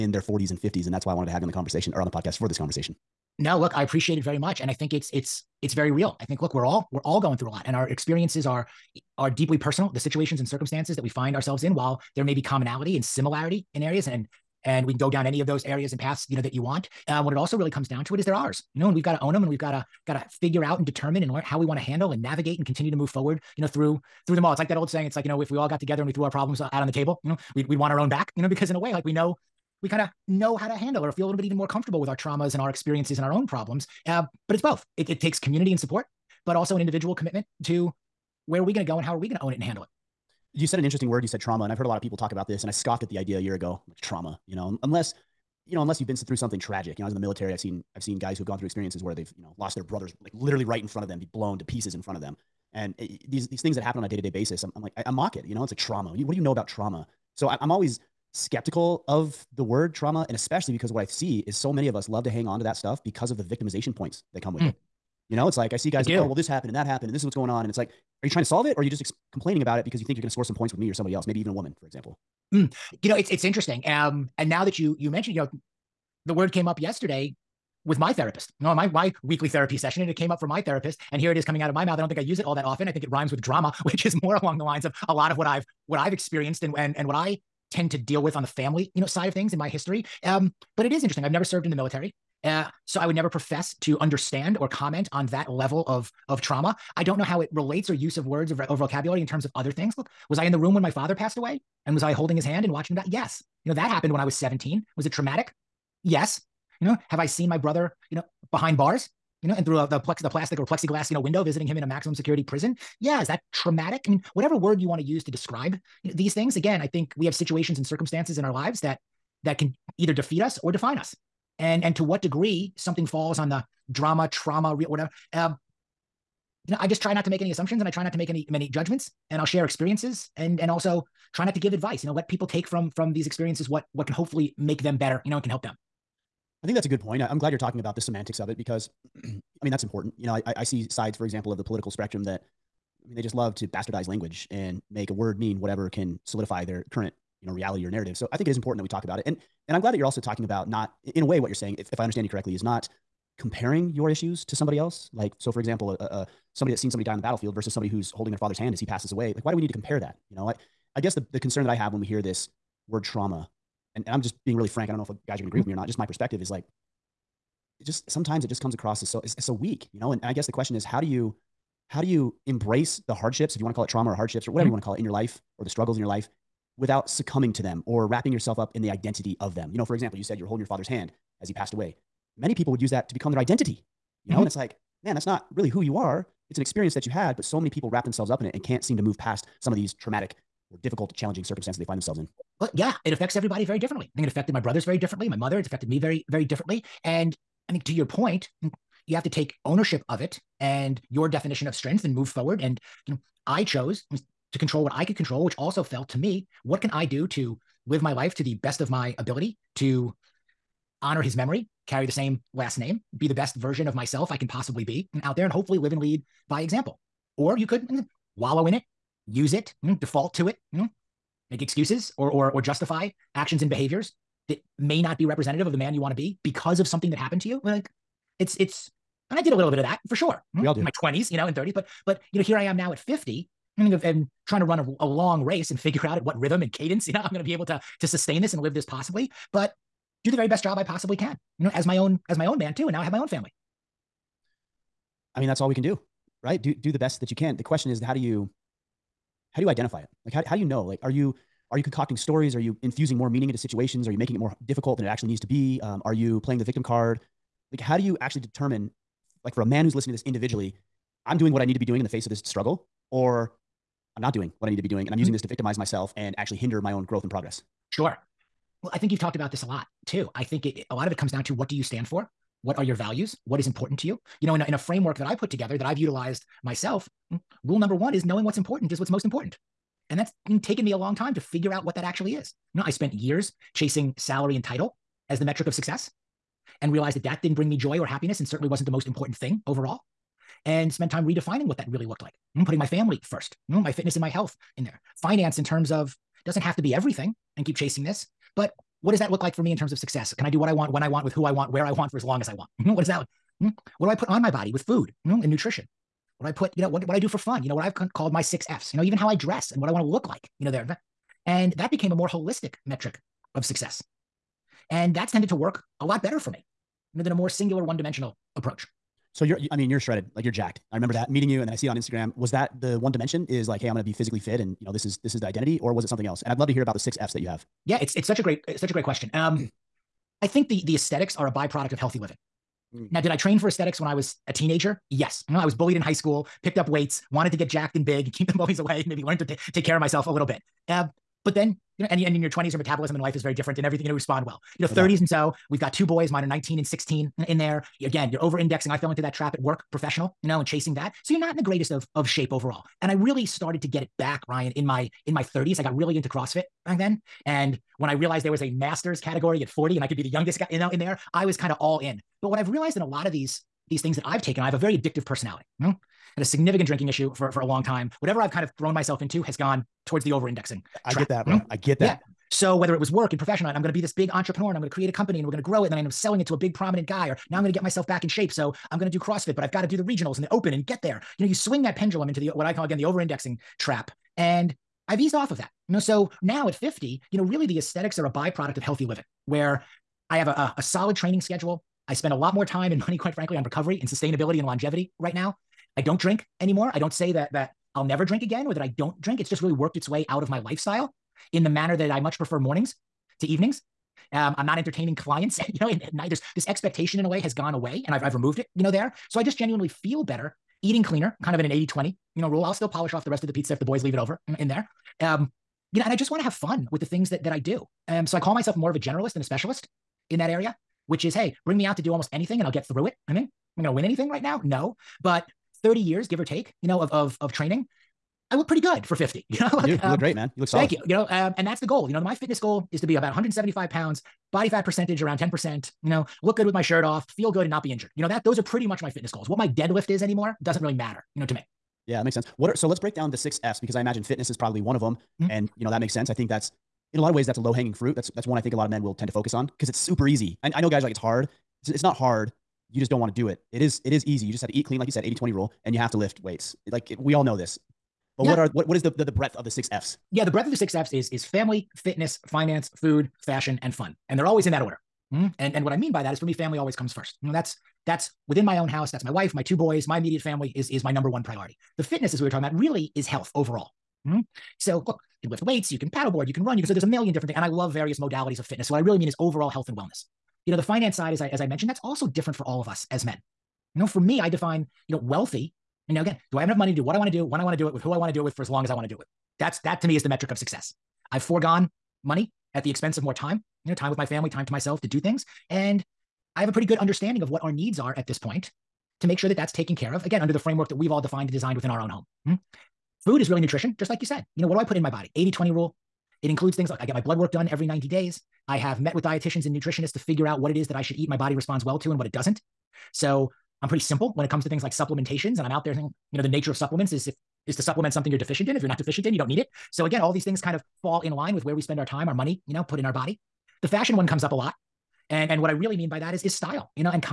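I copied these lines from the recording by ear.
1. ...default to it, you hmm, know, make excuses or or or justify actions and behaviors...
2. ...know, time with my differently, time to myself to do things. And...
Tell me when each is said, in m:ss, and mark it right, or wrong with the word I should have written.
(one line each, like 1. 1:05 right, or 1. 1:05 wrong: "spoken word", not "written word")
1. 3:40 right
2. 8:13 wrong: "family", not "differently".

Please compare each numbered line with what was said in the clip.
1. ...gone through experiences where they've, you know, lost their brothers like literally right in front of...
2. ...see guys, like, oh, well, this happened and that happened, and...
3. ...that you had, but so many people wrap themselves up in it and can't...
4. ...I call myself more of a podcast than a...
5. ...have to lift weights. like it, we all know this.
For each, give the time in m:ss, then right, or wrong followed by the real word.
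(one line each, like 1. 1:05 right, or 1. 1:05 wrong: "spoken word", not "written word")
1. 0:48 right
2. 1:05 right
3. 3:06 right
4. 6:58 wrong: "generalist", not "podcast"
5. 7:35 right.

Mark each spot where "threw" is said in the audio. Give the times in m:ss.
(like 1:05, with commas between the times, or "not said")
0:26.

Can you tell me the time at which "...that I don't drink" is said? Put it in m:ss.
6:38.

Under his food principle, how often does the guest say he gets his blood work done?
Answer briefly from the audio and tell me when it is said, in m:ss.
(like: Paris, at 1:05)
every 90 days, at 8:27.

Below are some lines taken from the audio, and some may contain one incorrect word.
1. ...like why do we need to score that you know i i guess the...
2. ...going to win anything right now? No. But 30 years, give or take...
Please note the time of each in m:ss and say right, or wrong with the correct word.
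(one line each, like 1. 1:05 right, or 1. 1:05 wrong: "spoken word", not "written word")
1. 2:39 wrong: "compare", not "score"
2. 7:03 right.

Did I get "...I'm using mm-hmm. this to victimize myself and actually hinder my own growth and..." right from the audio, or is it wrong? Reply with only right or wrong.
right.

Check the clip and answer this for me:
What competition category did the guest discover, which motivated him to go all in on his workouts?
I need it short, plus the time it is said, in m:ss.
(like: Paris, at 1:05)
master's category, at 5:58.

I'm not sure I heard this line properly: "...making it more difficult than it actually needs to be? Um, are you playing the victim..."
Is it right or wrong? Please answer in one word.
right.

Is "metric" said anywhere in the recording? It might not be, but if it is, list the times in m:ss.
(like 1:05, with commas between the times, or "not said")
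4:45, 5:12, 8:10.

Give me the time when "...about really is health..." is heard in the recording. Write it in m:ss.
7:52.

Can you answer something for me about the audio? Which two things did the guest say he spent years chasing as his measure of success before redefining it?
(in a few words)
salary and title.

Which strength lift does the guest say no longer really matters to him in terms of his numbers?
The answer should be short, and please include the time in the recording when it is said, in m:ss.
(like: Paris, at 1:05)
deadlift, at 7:19.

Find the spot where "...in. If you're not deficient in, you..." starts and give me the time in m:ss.
8:38.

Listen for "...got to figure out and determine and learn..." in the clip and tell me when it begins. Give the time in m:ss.
0:20.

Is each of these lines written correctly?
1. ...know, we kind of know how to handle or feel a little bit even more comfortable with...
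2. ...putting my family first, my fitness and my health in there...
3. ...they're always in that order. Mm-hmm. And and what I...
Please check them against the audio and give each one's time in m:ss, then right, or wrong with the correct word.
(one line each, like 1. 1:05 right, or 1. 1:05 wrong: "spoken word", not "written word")
1. 0:29 right
2. 4:52 right
3. 7:44 right.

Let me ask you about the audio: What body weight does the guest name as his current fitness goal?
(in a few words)
175 pounds.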